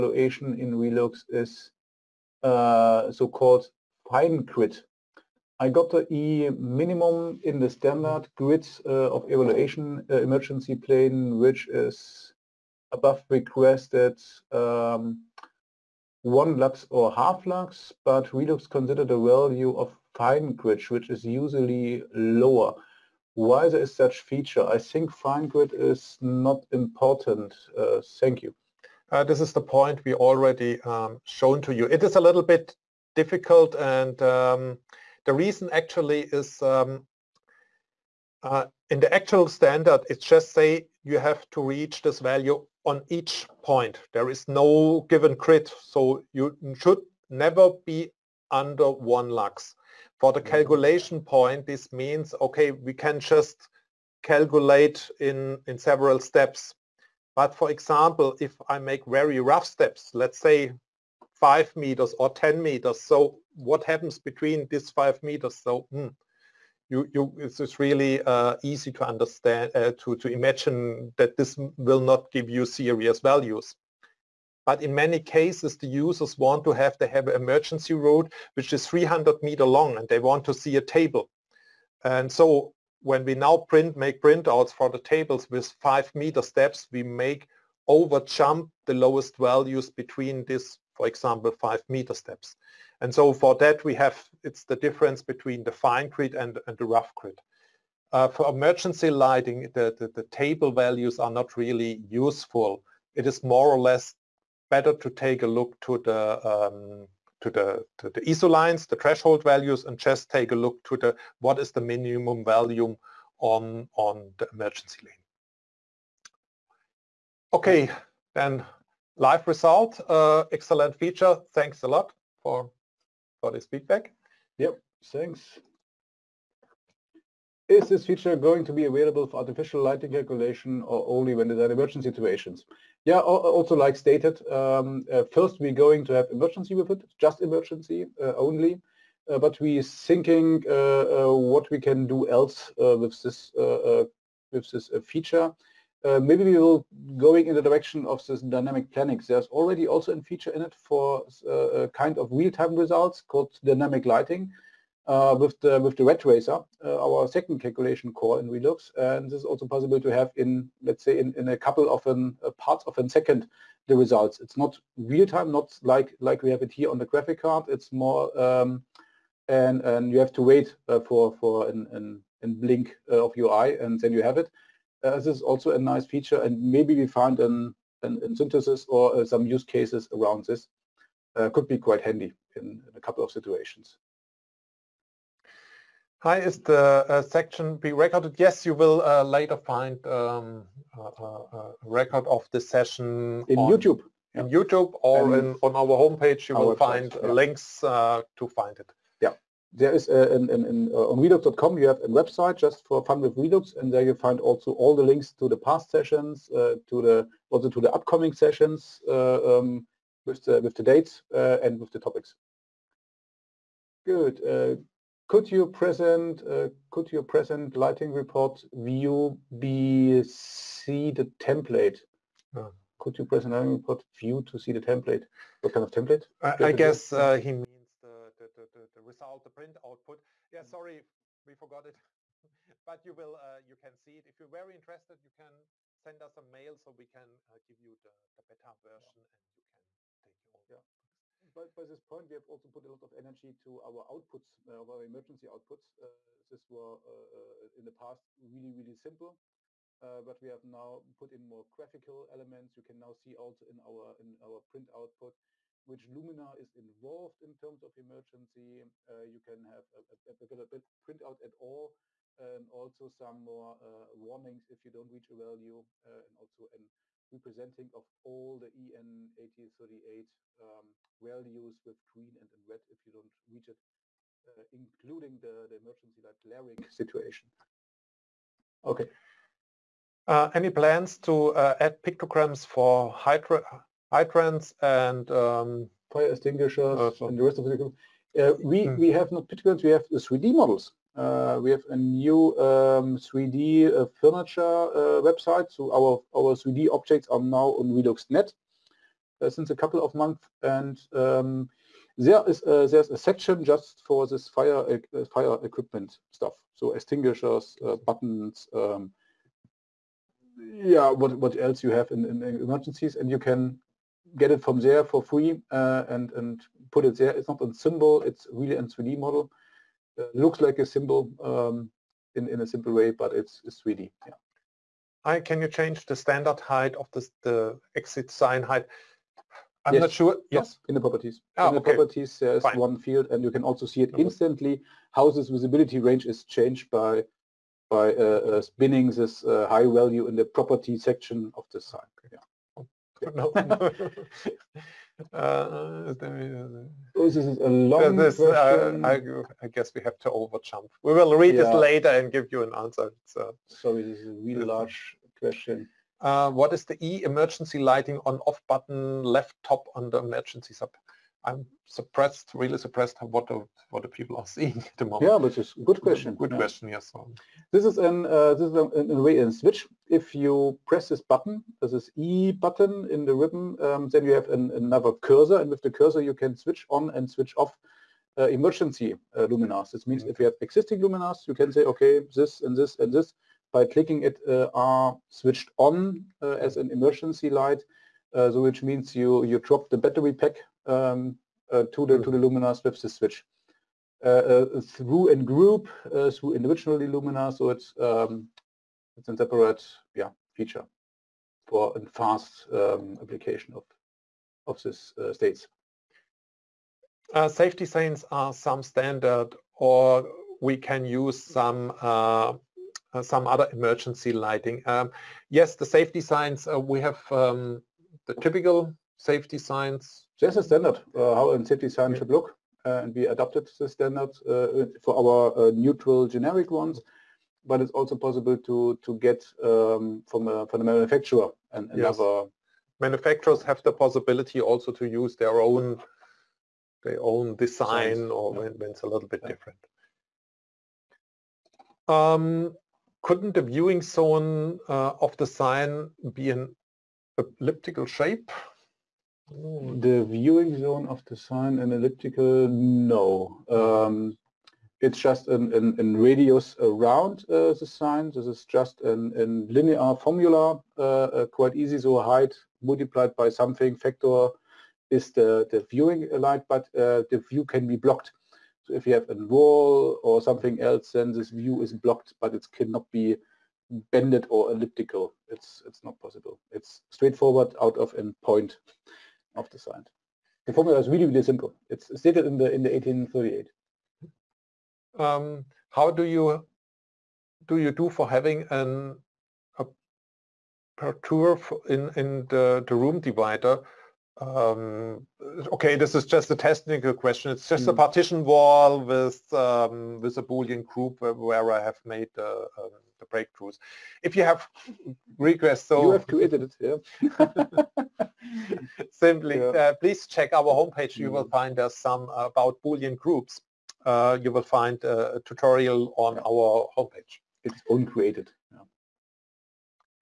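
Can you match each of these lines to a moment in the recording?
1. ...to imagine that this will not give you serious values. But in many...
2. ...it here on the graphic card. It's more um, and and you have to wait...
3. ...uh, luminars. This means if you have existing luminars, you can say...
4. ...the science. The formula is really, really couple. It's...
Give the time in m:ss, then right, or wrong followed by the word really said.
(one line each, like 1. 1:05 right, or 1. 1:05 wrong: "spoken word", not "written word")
1. 1:10 right
2. 2:46 right
3. 6:19 right
4. 7:59 wrong: "simple", not "couple".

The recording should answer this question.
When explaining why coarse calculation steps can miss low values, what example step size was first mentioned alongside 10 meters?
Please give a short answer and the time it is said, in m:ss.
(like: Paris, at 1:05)
5 meters, at 1:01.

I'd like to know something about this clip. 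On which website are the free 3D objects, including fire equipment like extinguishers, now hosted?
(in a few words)
Relux.net.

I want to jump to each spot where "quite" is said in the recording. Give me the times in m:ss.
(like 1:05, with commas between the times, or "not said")
3:01, 7:41.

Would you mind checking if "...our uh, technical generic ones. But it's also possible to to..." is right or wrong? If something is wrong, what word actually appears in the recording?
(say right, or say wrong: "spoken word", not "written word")
wrong: "neutral", not "technical".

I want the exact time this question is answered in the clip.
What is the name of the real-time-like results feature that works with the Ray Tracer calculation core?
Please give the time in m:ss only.
2:33.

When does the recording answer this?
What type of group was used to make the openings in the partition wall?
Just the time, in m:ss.
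8:20.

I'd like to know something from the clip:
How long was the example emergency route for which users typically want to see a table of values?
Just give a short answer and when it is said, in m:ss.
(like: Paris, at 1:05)
300 meters, at 1:18.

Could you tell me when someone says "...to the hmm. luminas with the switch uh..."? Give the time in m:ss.
6:32.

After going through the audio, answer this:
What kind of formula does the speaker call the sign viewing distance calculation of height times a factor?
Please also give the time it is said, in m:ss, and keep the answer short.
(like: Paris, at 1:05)
linear formula, at 7:39.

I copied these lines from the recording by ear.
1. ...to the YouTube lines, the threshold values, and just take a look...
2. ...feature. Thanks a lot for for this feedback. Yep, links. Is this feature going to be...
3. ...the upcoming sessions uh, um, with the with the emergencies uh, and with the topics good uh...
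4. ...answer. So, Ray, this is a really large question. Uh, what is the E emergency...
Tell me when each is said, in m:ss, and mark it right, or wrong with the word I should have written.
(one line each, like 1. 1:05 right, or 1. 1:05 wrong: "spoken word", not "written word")
1. 1:47 wrong: "ISO", not "YouTube"
2. 2:00 wrong: "thanks", not "links"
3. 3:27 wrong: "dates", not "emergencies"
4. 5:52 wrong: "Sorry", not "Ray".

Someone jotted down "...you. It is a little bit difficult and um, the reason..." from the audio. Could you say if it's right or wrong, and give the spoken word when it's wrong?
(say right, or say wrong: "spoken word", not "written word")
right.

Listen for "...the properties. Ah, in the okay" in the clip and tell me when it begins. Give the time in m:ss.
5:30.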